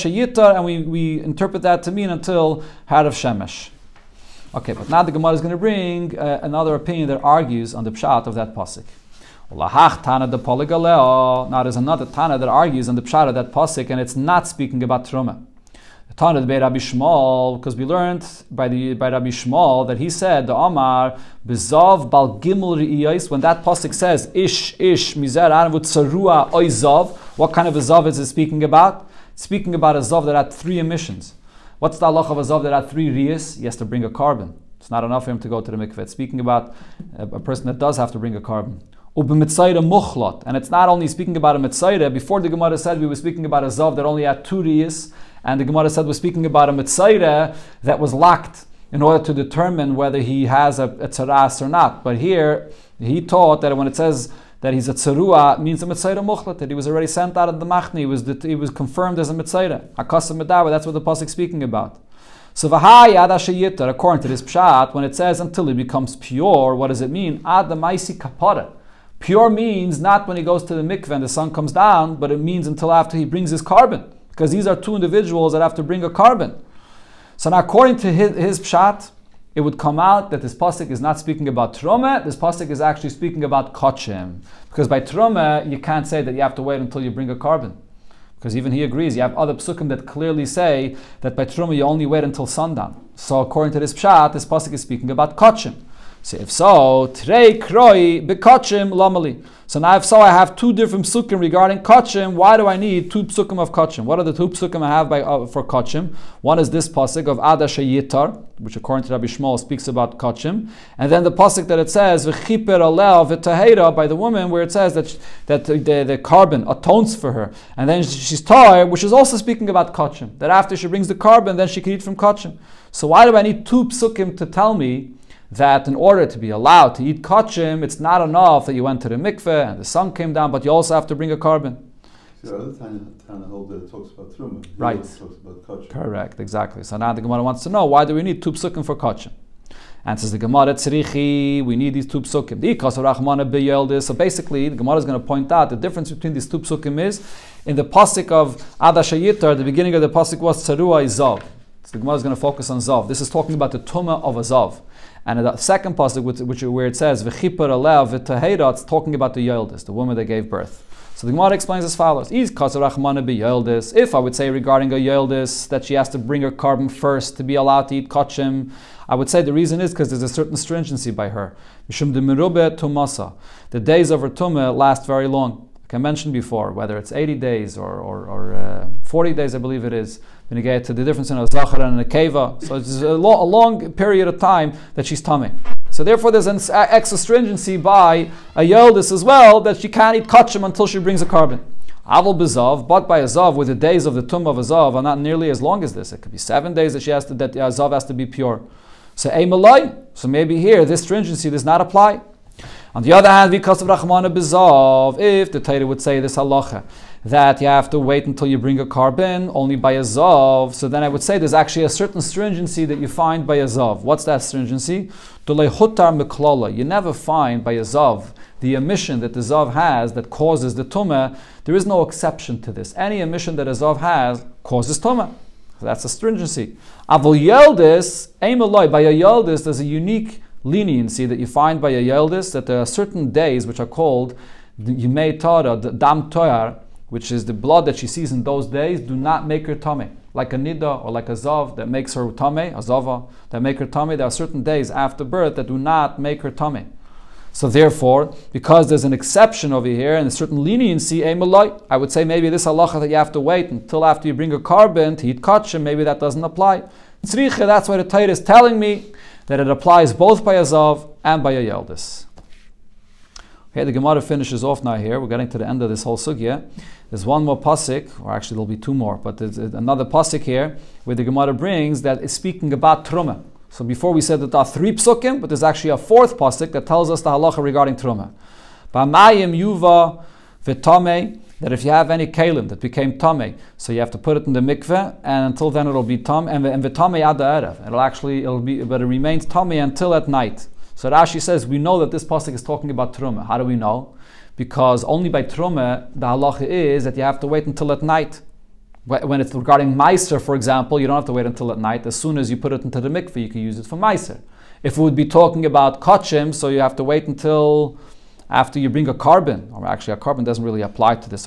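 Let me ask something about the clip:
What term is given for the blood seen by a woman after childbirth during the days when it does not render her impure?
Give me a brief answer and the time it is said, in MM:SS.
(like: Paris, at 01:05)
Dam Toyar, at 03:55.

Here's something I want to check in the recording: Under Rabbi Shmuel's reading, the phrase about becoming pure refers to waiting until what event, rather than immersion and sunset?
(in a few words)
Kapara.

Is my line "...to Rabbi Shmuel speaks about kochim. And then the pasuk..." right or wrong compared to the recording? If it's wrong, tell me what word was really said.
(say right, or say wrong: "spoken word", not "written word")
right.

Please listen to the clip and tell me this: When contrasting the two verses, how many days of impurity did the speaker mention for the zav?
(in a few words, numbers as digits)
7.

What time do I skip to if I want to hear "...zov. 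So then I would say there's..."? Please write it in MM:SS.
03:30.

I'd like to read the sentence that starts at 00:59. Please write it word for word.
Akasa medawa, that's what the pasuk speaking about.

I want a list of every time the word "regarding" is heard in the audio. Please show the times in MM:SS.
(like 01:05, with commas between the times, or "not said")
01:41, 02:44, 04:37, 04:59.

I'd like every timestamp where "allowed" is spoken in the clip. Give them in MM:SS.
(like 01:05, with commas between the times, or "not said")
02:06, 02:47.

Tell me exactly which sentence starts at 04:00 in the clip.
Like a nida or like a zav that makes her tummy, a zava that make her tummy.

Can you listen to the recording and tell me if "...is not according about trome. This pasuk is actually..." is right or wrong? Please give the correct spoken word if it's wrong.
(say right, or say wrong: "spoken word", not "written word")
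wrong: "speaking", not "according".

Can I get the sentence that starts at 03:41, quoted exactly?
There is no exception to this.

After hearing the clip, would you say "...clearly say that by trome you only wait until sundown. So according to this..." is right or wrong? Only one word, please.
right.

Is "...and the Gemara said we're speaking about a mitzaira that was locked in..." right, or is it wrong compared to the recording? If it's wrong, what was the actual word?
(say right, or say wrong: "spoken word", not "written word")
right.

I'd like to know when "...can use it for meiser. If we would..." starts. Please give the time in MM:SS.
05:03.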